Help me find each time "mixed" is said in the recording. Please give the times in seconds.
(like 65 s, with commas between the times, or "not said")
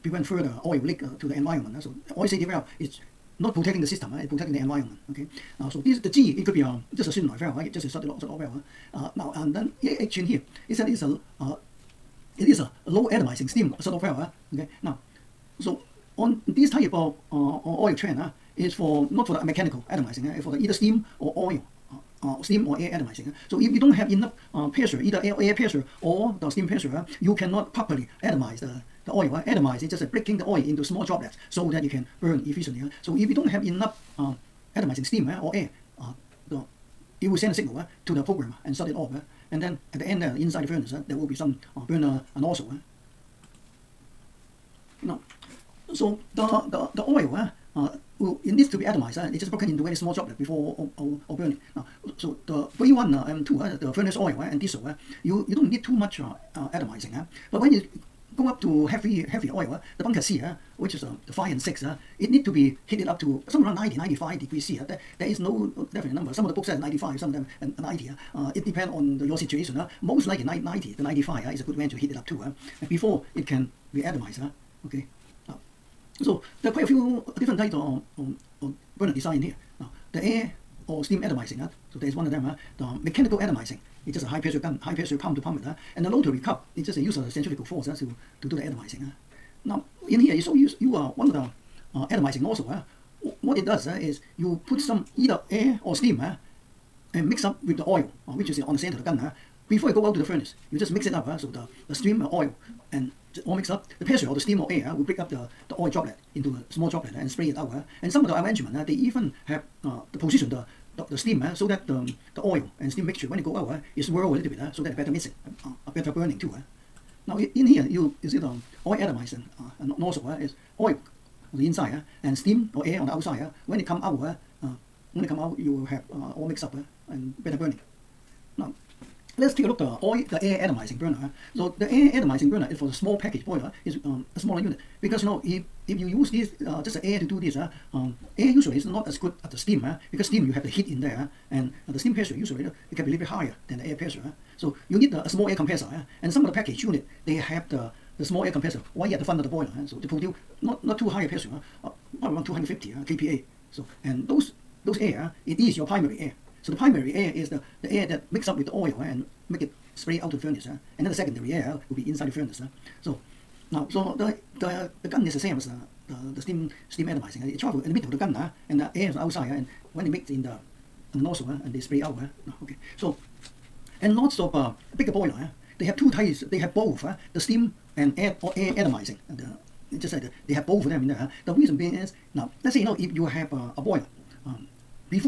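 103 s, 126 s.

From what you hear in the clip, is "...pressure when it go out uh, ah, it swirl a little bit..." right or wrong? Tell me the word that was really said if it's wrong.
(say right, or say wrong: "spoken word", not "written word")
wrong: "mixture", not "pressure".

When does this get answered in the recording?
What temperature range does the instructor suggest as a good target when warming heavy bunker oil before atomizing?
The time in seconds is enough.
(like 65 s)
70 s.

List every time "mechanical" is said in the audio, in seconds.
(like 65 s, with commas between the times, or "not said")
19 s, 83 s.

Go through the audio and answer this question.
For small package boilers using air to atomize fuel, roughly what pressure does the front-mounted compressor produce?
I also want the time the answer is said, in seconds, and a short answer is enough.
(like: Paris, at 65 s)
250 kPa, at 152 s.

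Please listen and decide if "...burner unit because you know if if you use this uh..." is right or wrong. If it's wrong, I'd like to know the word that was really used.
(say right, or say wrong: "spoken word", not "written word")
wrong: "smaller", not "burner".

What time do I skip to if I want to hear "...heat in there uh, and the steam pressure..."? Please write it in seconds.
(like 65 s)
140 s.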